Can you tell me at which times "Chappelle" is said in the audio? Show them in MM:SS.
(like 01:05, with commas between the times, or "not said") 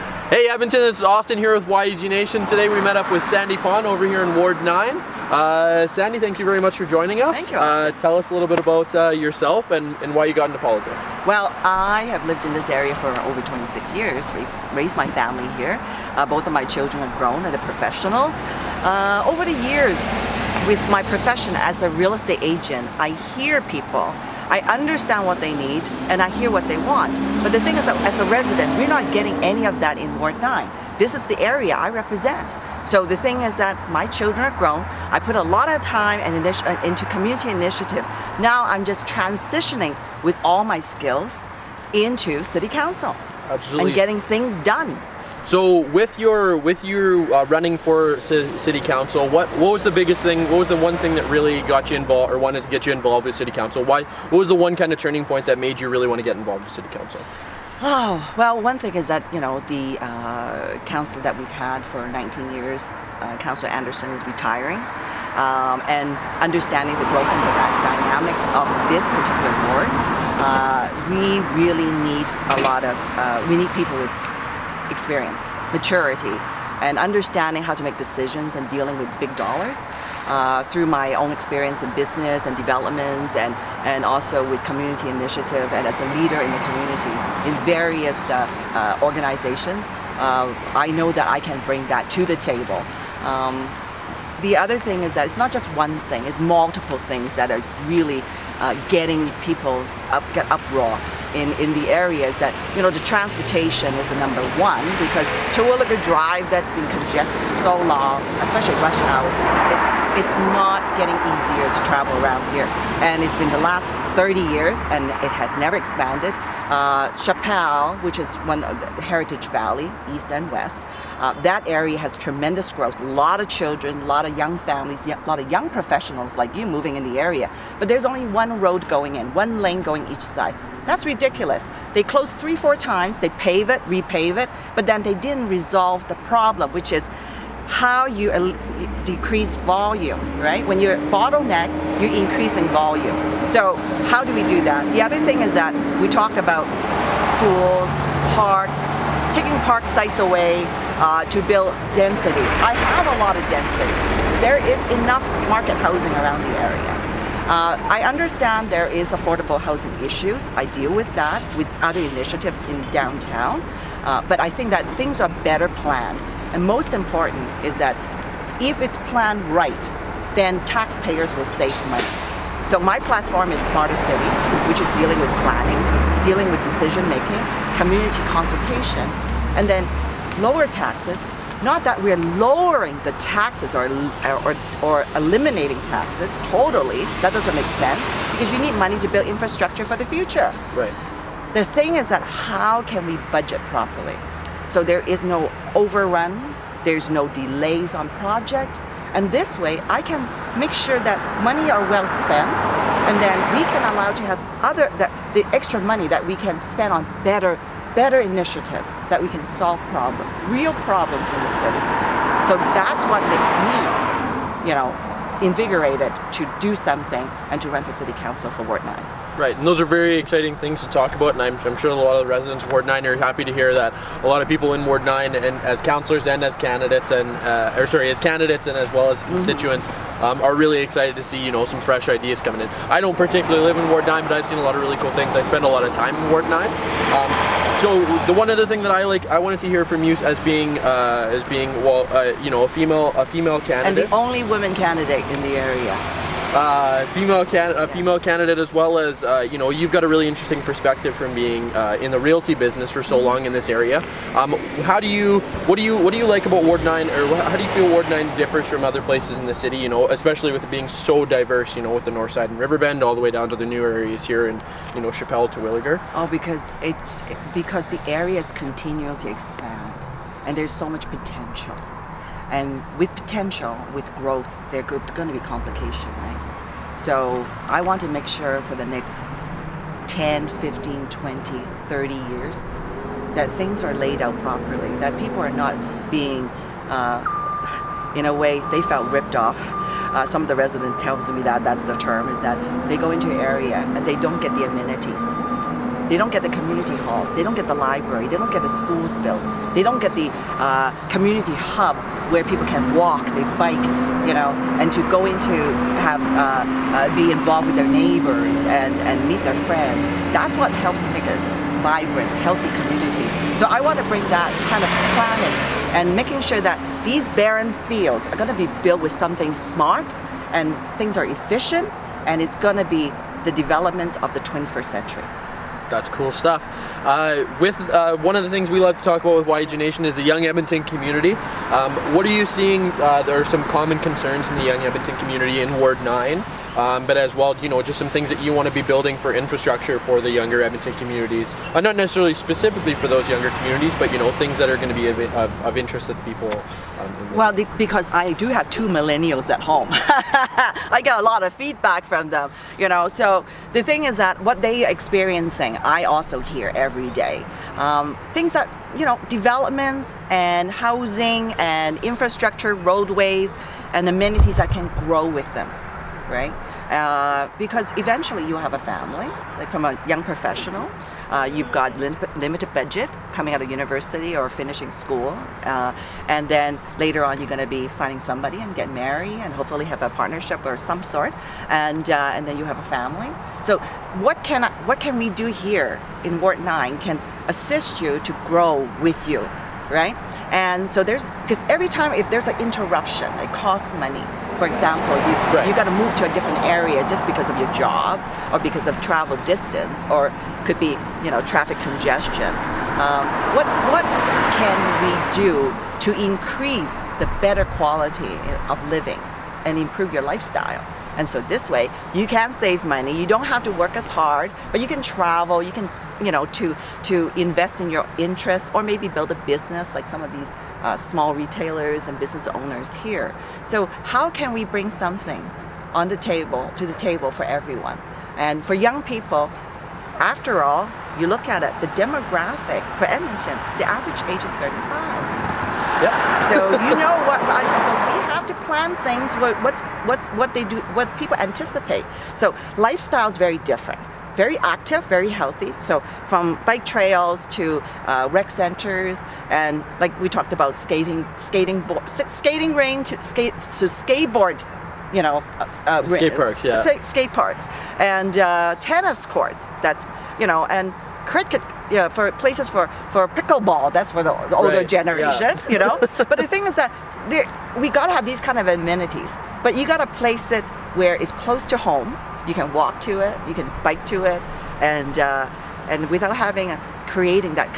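01:57, 04:25.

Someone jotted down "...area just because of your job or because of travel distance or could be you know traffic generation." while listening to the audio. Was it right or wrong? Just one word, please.
wrong.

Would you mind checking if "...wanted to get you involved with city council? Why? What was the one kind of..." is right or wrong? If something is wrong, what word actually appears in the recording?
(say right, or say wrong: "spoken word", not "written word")
right.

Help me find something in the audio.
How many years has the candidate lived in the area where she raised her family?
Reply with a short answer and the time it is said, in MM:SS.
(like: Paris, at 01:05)
over 26 years, at 00:13.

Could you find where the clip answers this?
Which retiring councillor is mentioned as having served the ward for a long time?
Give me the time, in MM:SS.
01:03.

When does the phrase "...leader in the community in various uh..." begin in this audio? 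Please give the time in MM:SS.
01:26.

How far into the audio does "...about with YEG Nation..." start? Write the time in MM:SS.
05:29.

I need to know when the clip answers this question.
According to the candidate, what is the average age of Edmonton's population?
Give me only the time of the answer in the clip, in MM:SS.
07:14.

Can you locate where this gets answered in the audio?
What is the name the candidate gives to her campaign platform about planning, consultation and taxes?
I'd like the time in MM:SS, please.
02:53.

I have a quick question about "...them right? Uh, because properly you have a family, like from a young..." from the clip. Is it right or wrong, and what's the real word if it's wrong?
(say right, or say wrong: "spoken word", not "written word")
wrong: "eventually", not "properly".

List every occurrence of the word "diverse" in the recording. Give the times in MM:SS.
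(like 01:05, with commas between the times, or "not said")
04:21.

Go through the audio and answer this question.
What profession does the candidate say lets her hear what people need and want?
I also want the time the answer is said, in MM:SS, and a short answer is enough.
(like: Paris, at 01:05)
real estate agent, at 00:21.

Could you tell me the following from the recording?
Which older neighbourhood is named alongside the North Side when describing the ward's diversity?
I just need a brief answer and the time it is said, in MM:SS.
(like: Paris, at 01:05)
Riverbend, at 04:22.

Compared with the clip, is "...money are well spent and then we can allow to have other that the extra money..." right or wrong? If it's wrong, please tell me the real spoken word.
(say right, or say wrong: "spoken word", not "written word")
right.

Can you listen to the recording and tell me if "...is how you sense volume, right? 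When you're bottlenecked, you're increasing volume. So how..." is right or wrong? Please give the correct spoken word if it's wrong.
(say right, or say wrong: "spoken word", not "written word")
wrong: "decrease", not "sense".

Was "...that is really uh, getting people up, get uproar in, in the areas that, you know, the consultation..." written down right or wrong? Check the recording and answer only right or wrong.
wrong.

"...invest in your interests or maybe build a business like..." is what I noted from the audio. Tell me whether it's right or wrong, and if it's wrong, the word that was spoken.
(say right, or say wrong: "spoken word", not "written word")
right.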